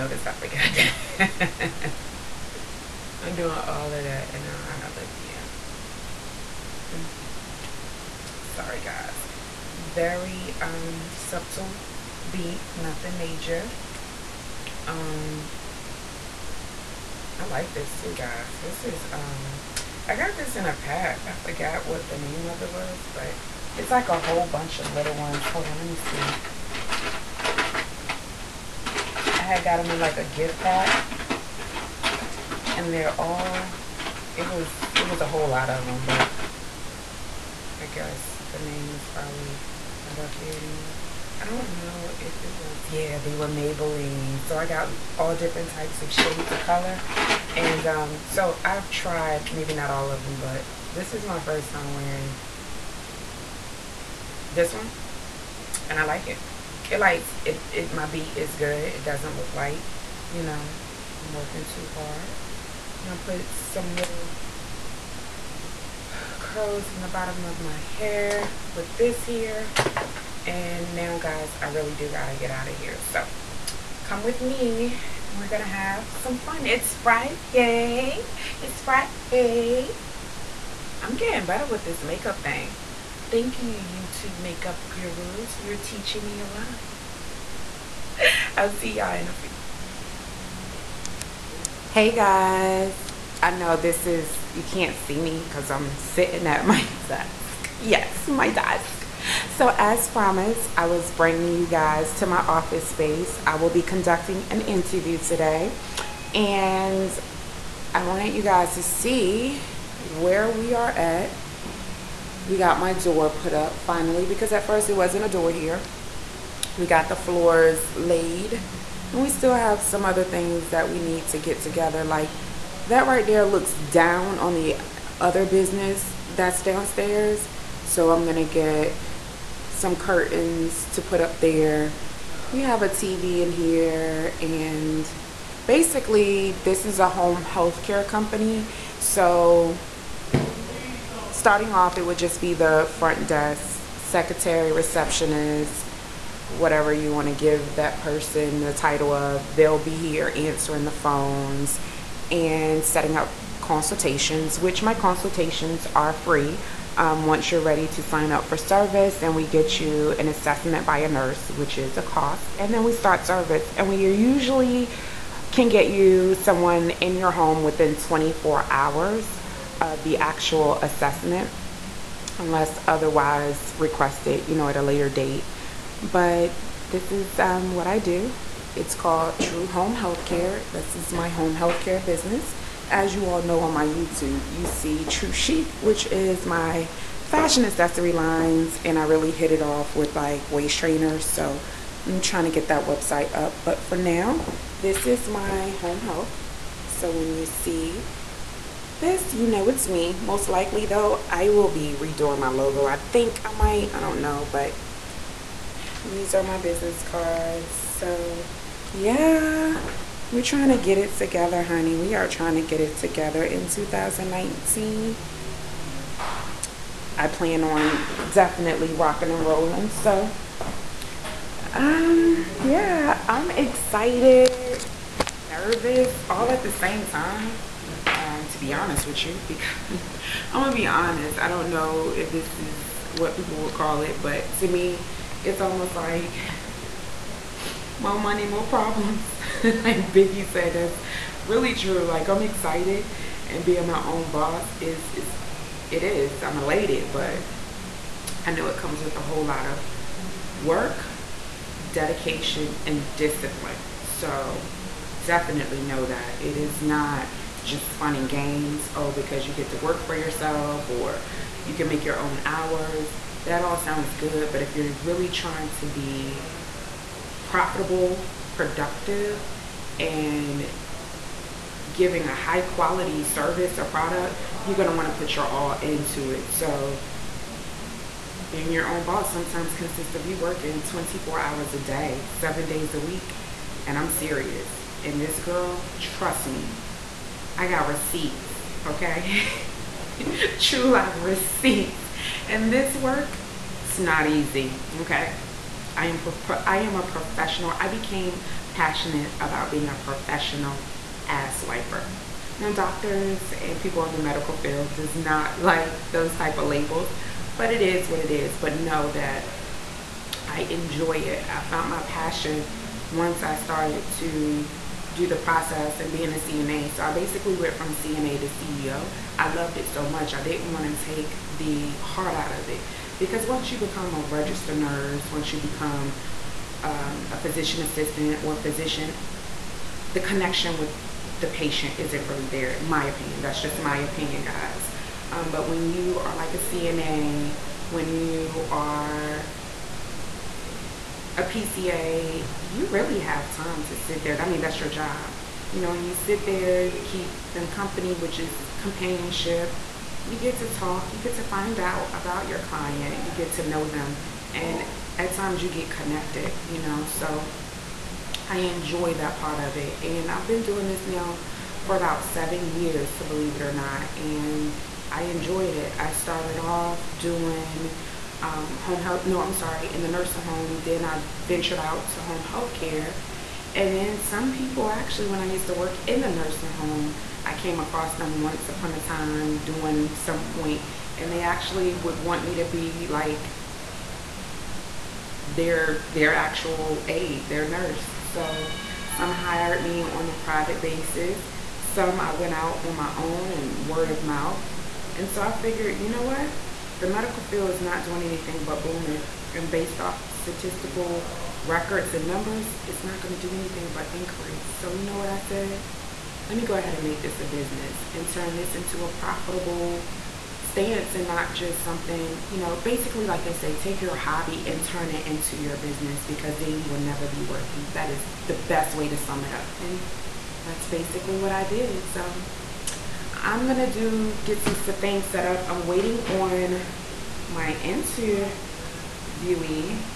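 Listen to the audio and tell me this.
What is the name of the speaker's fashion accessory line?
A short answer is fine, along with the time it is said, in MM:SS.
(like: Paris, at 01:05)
Tru Chic, at 03:05.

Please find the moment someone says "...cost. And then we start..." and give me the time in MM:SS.
02:42.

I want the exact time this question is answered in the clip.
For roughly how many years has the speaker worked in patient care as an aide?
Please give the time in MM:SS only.
06:02.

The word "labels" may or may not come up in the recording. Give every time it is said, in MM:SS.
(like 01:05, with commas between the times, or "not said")
05:06.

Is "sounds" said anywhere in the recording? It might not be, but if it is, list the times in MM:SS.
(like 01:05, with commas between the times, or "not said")
04:23.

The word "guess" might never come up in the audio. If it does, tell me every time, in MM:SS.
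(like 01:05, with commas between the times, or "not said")
00:37.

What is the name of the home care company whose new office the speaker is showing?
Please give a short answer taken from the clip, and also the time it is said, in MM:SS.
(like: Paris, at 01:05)
True Home Healthcare, at 02:59.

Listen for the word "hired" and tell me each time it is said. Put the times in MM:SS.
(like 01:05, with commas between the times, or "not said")
06:29.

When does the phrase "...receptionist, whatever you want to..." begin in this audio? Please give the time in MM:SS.
02:24.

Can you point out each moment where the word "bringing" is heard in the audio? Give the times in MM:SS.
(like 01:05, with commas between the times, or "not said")
01:41.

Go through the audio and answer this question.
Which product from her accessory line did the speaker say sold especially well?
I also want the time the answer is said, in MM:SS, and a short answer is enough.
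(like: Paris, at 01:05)
waist trainers, at 03:10.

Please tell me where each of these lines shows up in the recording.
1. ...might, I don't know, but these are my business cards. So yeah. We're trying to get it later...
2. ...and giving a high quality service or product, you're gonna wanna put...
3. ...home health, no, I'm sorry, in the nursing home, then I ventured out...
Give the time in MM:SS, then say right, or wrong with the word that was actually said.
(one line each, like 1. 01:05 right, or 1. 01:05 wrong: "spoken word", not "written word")
1. 03:23 wrong: "together", not "later"
2. 04:29 right
3. 06:08 right.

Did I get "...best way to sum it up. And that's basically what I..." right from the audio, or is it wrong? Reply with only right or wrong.
right.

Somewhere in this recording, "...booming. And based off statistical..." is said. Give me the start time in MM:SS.
06:38.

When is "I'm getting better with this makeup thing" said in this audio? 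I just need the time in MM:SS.
01:21.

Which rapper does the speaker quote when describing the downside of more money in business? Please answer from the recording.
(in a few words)
Biggie.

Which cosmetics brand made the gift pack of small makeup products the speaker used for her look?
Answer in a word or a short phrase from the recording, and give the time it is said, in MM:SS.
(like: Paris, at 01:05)
Maybelline, at 00:43.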